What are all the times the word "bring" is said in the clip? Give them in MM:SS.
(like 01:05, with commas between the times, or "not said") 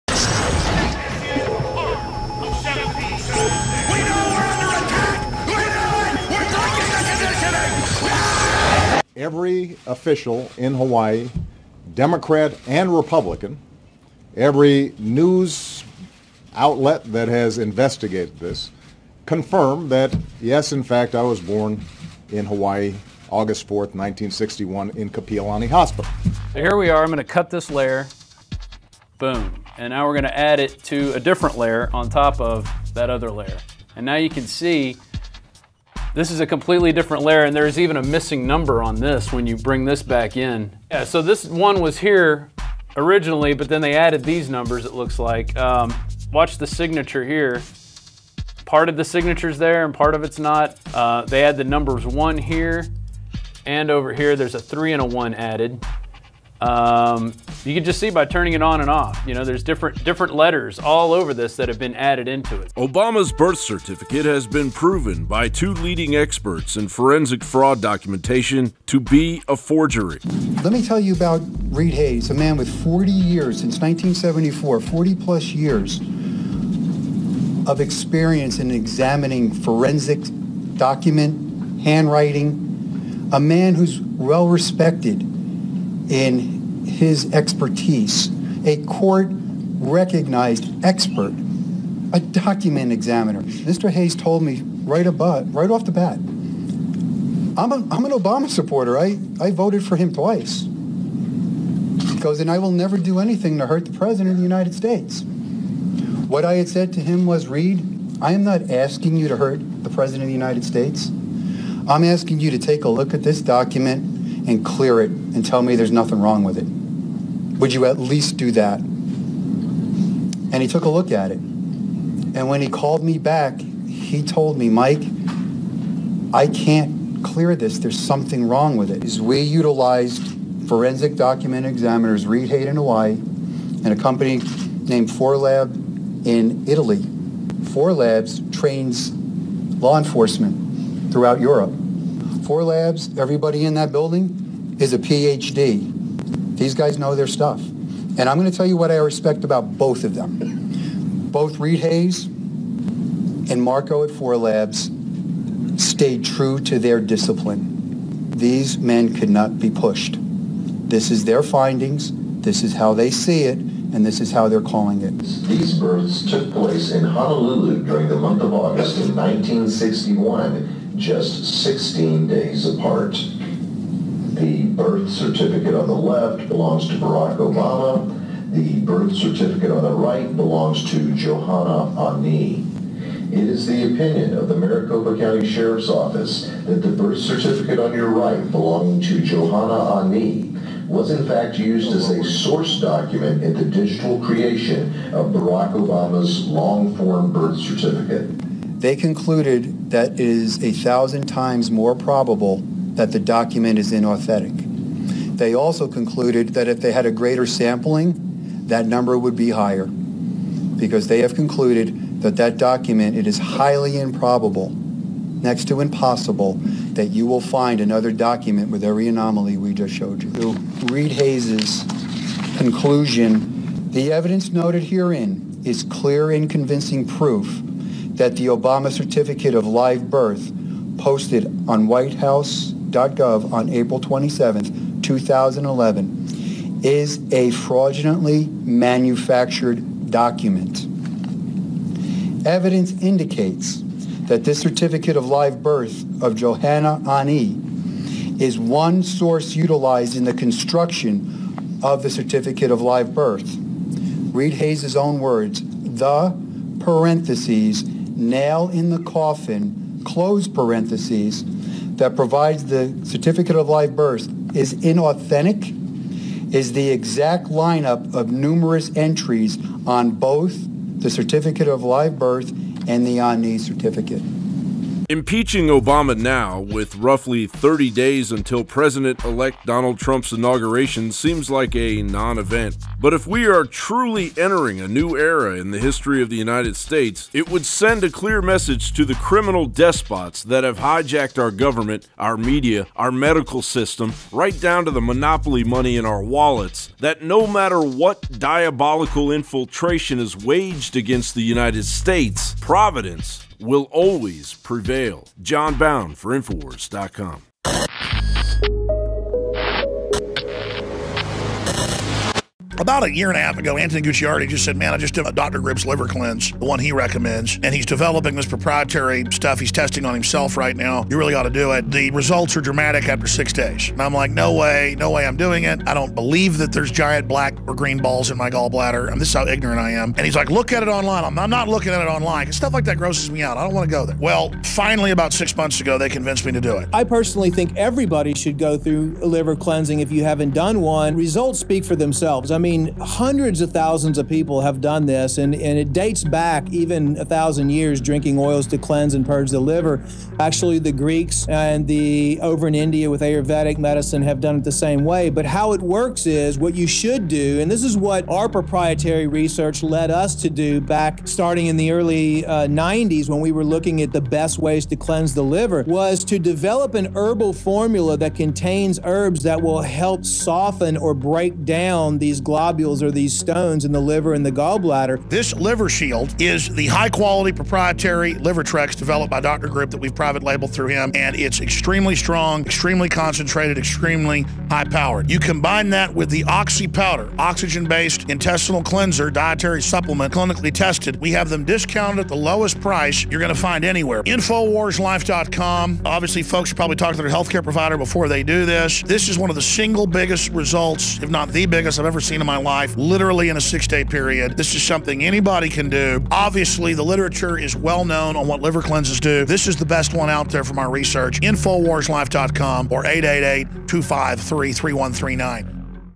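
00:39.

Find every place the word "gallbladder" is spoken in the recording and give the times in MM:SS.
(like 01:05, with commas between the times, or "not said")
05:28, 06:14.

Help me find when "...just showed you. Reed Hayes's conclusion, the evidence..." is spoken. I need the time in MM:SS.
03:39.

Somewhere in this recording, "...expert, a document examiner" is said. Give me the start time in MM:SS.
01:30.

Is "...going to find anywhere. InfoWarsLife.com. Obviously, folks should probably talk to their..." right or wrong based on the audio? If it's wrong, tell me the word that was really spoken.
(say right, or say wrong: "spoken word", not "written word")
right.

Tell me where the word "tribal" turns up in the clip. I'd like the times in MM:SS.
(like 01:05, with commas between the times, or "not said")
not said.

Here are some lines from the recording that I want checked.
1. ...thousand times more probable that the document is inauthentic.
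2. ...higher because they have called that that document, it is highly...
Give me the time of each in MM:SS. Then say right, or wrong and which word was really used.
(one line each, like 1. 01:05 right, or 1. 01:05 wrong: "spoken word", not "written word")
1. 03:20 right
2. 03:29 wrong: "concluded", not "called".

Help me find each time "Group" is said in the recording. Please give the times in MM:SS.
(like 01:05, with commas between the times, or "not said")
05:15, 06:19.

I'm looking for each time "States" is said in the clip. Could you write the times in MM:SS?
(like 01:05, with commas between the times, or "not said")
01:44, 01:50, 04:46, 05:01.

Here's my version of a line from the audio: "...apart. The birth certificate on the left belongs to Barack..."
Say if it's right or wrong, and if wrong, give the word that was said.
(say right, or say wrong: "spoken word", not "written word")
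right.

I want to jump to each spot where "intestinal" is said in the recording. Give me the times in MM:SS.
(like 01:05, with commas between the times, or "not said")
06:28.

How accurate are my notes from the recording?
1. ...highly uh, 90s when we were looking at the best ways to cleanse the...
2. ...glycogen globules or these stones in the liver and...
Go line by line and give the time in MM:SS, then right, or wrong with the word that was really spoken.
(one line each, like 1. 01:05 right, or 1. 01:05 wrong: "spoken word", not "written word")
1. 06:01 wrong: "early", not "highly"
2. 06:12 right.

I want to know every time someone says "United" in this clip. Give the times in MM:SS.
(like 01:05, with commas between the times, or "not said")
01:44, 01:50, 04:46, 05:01.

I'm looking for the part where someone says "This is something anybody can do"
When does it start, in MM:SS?
06:44.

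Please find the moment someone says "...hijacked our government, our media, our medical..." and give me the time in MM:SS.
04:50.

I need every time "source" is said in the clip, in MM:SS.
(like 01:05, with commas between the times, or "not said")
03:12, 04:09.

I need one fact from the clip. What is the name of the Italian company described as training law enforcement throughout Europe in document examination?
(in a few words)
Forlab.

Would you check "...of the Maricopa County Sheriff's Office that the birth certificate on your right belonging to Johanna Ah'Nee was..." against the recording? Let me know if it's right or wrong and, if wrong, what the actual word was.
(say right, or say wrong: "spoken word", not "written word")
right.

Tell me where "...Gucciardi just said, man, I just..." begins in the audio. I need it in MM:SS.
05:14.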